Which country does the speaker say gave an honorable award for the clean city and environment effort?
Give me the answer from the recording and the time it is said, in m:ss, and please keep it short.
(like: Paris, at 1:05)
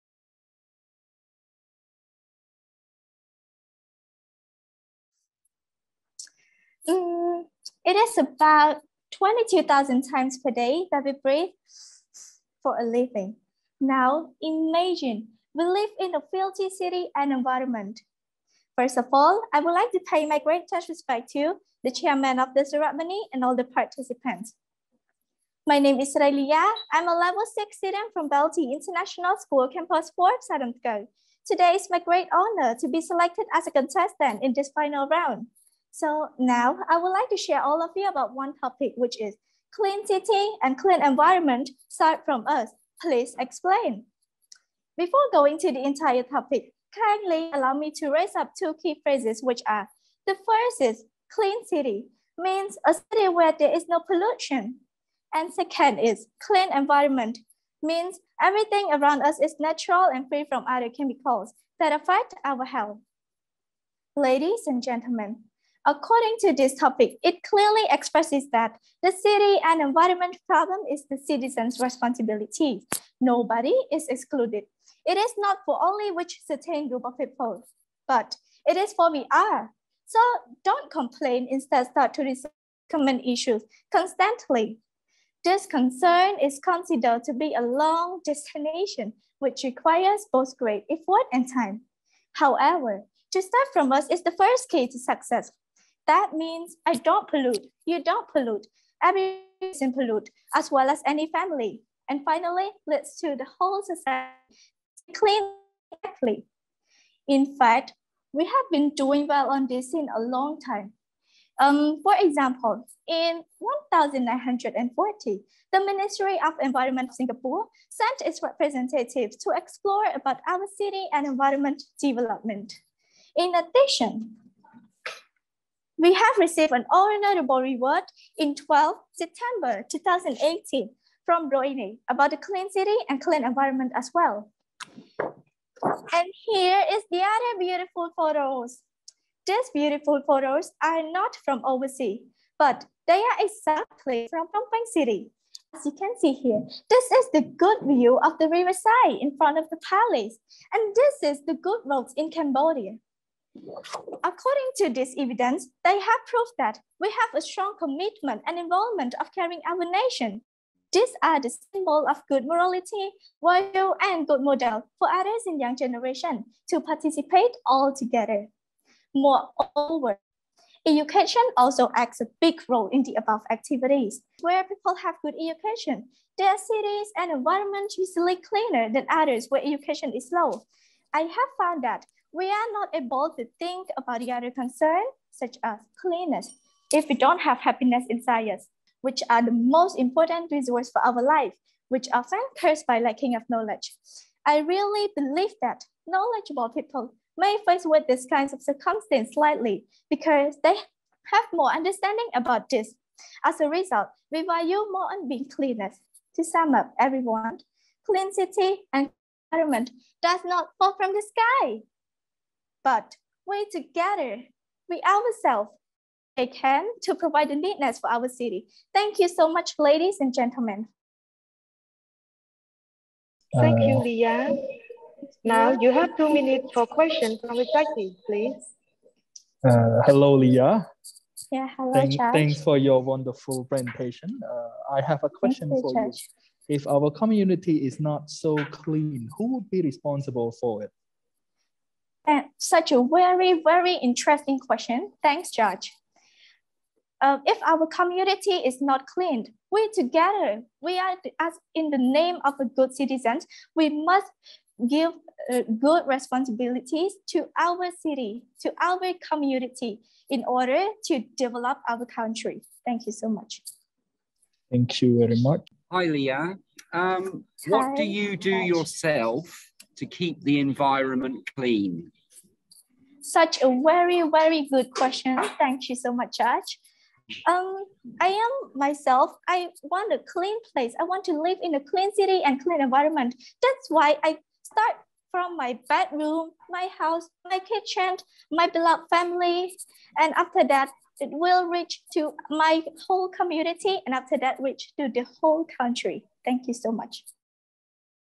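Brunei, at 2:11.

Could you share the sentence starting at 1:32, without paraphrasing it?
However, to start from us is the first key to success.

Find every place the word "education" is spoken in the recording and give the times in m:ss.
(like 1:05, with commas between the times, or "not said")
2:50, 2:55, 2:59.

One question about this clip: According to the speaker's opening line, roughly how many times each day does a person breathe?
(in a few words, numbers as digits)
22,000.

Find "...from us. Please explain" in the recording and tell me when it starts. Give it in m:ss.
0:42.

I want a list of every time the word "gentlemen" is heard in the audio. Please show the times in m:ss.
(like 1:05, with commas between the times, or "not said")
1:04, 3:40.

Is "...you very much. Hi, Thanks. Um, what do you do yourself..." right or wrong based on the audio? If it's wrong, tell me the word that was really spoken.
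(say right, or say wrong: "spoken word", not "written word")
wrong: "Liya", not "Thanks".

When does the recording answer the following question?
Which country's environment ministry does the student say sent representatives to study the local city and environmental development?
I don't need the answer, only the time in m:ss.
1:57.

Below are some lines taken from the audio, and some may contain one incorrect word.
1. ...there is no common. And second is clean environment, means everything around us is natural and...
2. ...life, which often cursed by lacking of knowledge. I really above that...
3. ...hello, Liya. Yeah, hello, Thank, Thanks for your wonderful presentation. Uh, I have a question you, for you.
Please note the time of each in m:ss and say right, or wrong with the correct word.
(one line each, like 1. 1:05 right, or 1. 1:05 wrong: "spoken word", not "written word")
1. 0:53 wrong: "pollution", not "common"
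2. 3:11 wrong: "believe", not "above"
3. 3:50 right.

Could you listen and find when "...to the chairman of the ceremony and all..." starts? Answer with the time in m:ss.
0:21.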